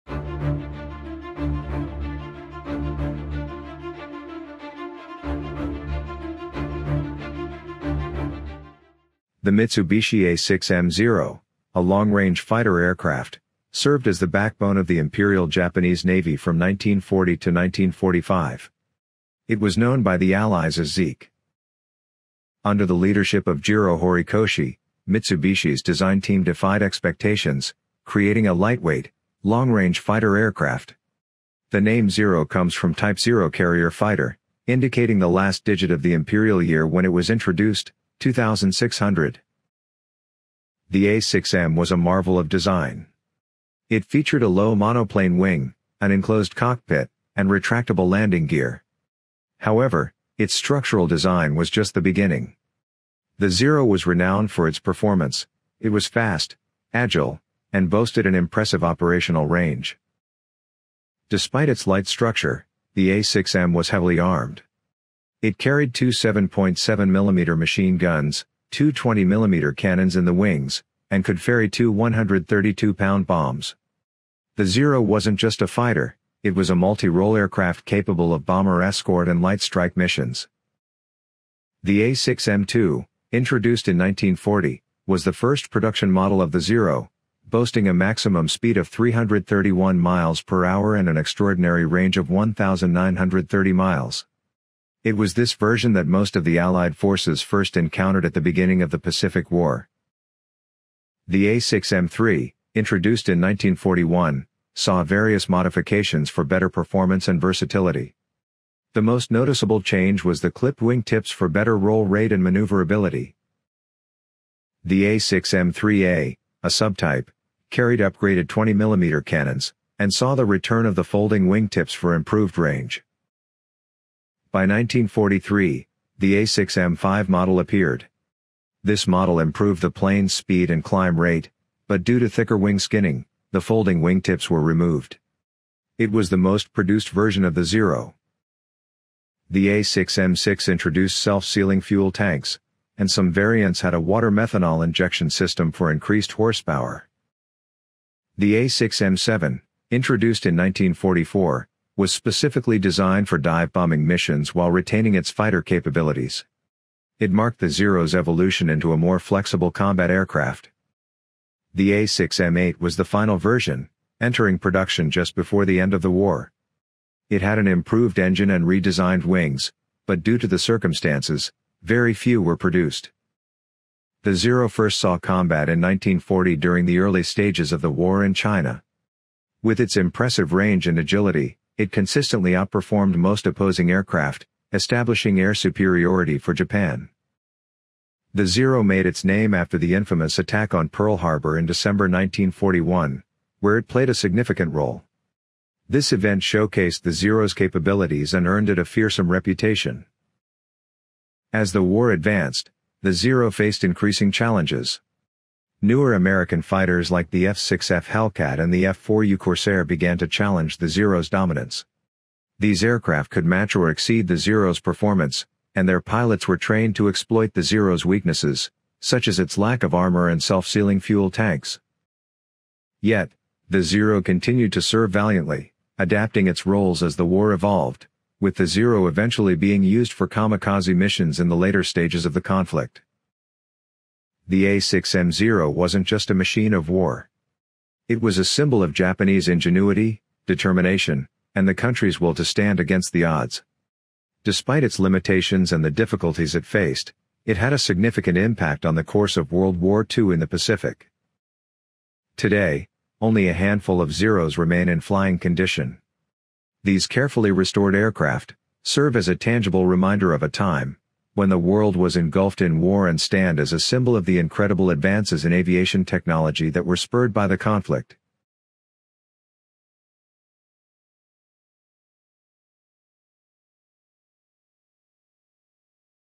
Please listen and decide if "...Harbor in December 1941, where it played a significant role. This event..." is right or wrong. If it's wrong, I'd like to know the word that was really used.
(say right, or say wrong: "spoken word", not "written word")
right.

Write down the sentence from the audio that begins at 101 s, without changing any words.
The A6M3, introduced in 1941, saw various modifications for better performance and versatility.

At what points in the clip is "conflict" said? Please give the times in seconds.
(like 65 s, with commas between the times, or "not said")
232 s, 267 s.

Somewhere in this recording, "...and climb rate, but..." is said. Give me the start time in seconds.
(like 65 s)
130 s.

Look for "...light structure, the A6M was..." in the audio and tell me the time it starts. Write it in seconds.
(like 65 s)
61 s.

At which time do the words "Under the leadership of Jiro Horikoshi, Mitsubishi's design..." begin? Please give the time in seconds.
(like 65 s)
22 s.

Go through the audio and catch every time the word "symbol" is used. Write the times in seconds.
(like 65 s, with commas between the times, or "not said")
238 s, 263 s.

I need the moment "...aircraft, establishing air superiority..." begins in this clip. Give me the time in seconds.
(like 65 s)
183 s.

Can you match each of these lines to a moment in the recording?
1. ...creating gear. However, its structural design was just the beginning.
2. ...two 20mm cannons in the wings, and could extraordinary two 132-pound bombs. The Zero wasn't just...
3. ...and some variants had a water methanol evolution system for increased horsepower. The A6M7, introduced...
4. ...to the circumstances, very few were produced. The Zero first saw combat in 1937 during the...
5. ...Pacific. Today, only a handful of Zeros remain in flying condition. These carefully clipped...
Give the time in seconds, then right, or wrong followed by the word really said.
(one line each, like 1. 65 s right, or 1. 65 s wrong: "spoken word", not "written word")
1. 48 s wrong: "landing", not "creating"
2. 68 s wrong: "ferry", not "extraordinary"
3. 142 s wrong: "injection", not "evolution"
4. 170 s wrong: "1940", not "1937"
5. 250 s wrong: "restored", not "clipped".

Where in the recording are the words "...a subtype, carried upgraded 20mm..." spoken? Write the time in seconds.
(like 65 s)
116 s.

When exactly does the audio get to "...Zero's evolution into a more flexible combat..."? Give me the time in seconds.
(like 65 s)
157 s.